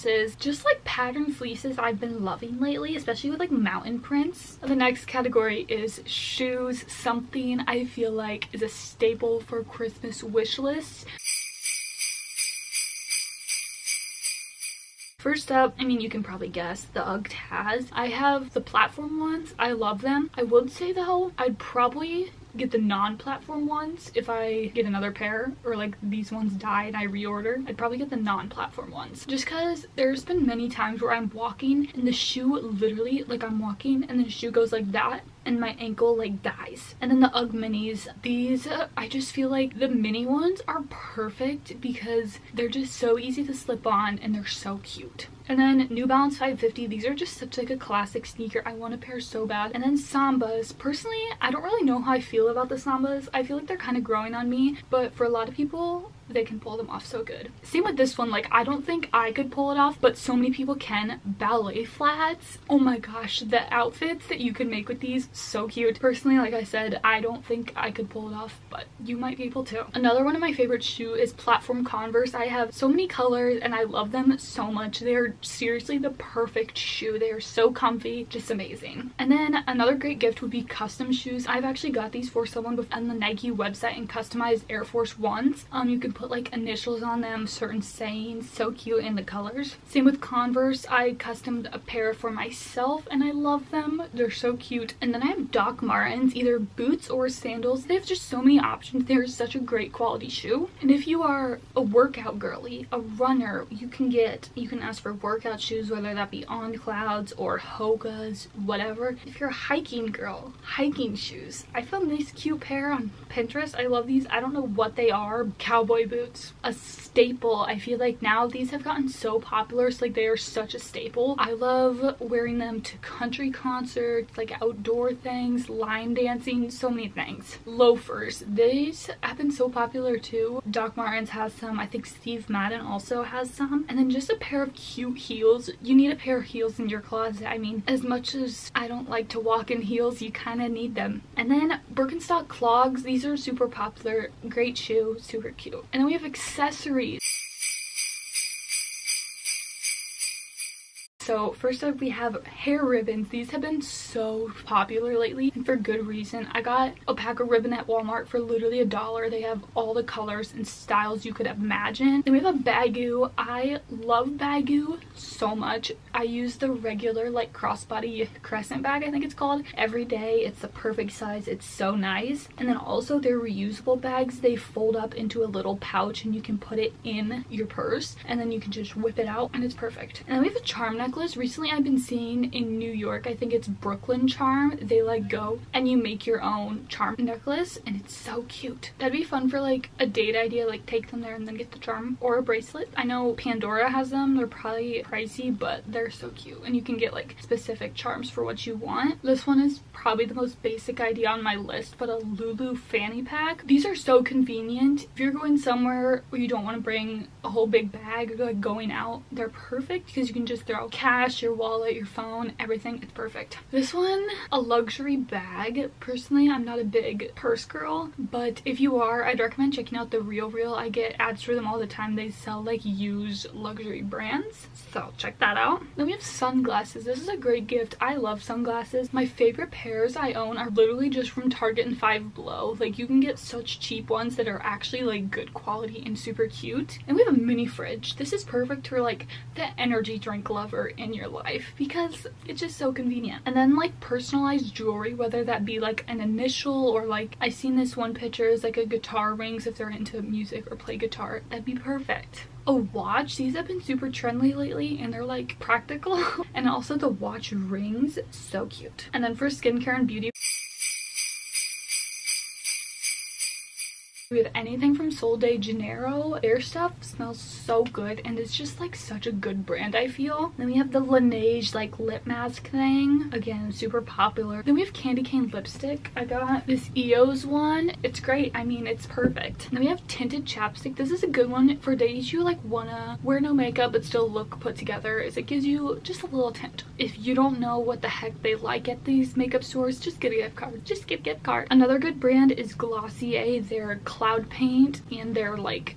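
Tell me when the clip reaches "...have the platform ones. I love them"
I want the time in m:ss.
0:18.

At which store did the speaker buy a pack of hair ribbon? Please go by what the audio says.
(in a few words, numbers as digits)
Walmart.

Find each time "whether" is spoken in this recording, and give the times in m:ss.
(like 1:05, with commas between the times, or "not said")
1:45, 4:05.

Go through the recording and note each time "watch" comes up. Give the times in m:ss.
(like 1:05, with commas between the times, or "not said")
4:12, 4:17.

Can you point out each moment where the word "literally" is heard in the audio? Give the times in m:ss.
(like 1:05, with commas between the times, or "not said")
0:32, 2:38, 3:50.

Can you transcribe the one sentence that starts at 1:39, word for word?
They're such a great quality shoe.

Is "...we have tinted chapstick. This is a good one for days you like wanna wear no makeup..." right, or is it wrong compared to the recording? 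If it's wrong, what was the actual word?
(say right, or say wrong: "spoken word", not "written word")
right.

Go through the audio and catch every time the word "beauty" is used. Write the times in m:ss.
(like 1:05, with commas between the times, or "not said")
4:20.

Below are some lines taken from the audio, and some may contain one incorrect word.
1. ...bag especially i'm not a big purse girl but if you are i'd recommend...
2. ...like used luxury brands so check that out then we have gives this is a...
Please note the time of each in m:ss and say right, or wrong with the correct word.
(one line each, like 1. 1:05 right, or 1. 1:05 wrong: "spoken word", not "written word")
1. 3:35 wrong: "personally", not "especially"
2. 3:42 wrong: "sunglasses", not "gives".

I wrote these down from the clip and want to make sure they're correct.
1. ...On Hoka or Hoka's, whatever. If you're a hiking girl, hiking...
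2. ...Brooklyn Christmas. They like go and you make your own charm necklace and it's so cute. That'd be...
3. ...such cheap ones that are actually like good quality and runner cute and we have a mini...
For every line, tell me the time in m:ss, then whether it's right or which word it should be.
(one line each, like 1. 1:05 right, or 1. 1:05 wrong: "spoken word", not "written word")
1. 1:46 wrong: "Clouds", not "Hoka"
2. 3:03 wrong: "Charm", not "Christmas"
3. 3:53 wrong: "super", not "runner".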